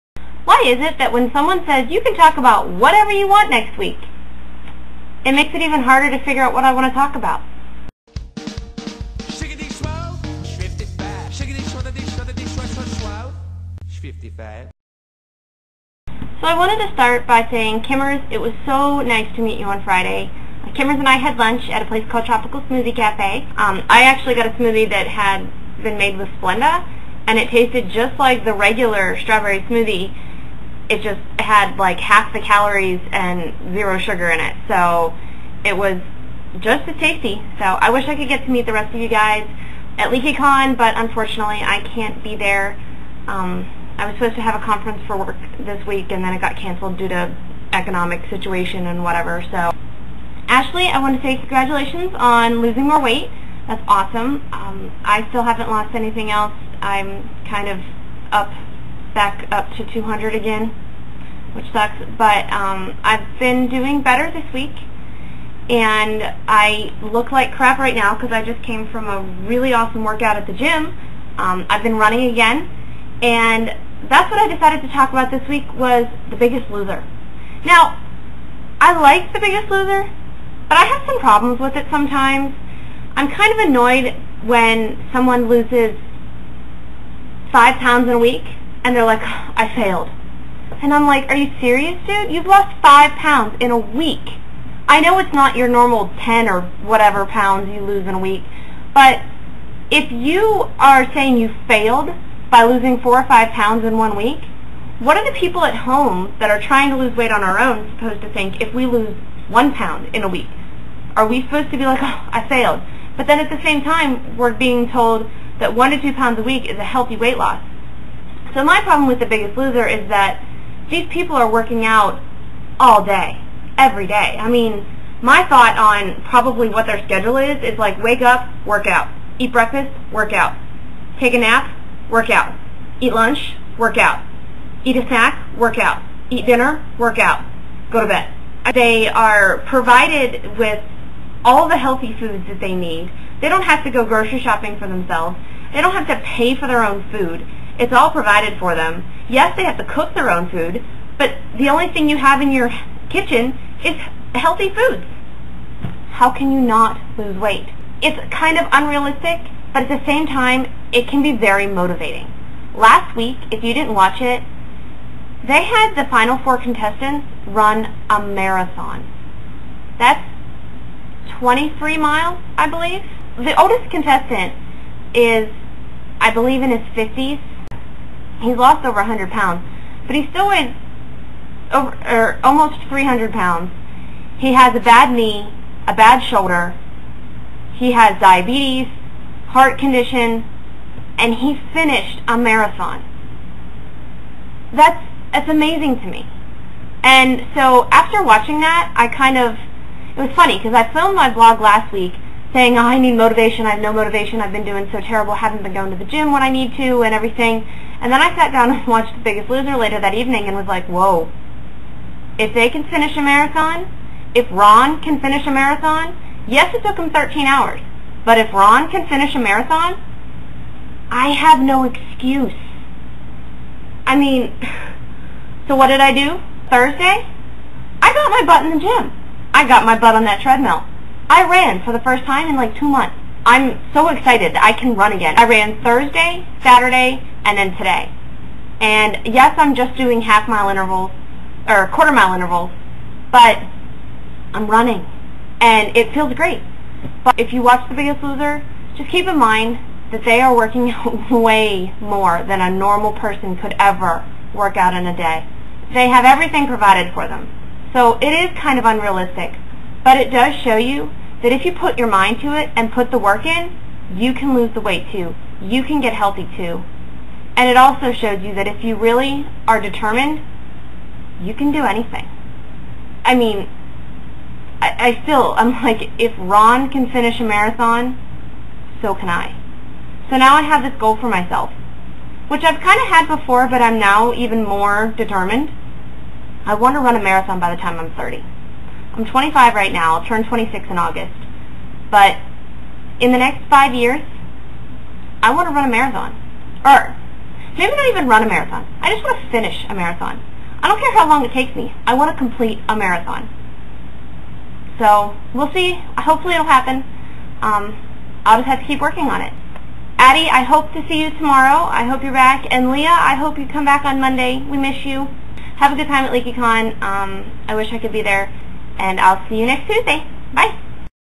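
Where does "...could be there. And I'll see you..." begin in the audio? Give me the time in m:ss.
5:17.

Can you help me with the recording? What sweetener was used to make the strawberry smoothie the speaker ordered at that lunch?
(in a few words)
Splenda.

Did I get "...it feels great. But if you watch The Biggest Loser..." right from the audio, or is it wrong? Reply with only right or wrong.
right.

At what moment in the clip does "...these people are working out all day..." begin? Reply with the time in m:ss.
2:00.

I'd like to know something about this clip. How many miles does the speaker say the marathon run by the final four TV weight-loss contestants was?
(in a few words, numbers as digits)
23 miles.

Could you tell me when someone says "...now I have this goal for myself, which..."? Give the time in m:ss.
4:40.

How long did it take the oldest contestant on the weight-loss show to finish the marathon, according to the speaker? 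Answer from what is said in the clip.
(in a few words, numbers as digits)
13 hours.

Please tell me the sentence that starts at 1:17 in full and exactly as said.
Now, I like The Biggest Loser, but I have some problems with it sometimes.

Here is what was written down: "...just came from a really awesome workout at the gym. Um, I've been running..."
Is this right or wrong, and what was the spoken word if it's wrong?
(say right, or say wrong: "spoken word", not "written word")
right.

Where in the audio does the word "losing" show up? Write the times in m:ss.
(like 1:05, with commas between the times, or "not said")
0:52, 1:42.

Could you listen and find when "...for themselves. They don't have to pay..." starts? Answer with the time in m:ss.
2:24.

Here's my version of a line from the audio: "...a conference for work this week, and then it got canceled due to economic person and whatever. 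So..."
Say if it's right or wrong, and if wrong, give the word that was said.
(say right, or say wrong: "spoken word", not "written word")
wrong: "situation", not "person".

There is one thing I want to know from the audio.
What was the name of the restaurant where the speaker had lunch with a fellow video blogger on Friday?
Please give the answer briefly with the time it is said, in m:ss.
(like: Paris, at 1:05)
Tropical Smoothie Cafe, at 0:22.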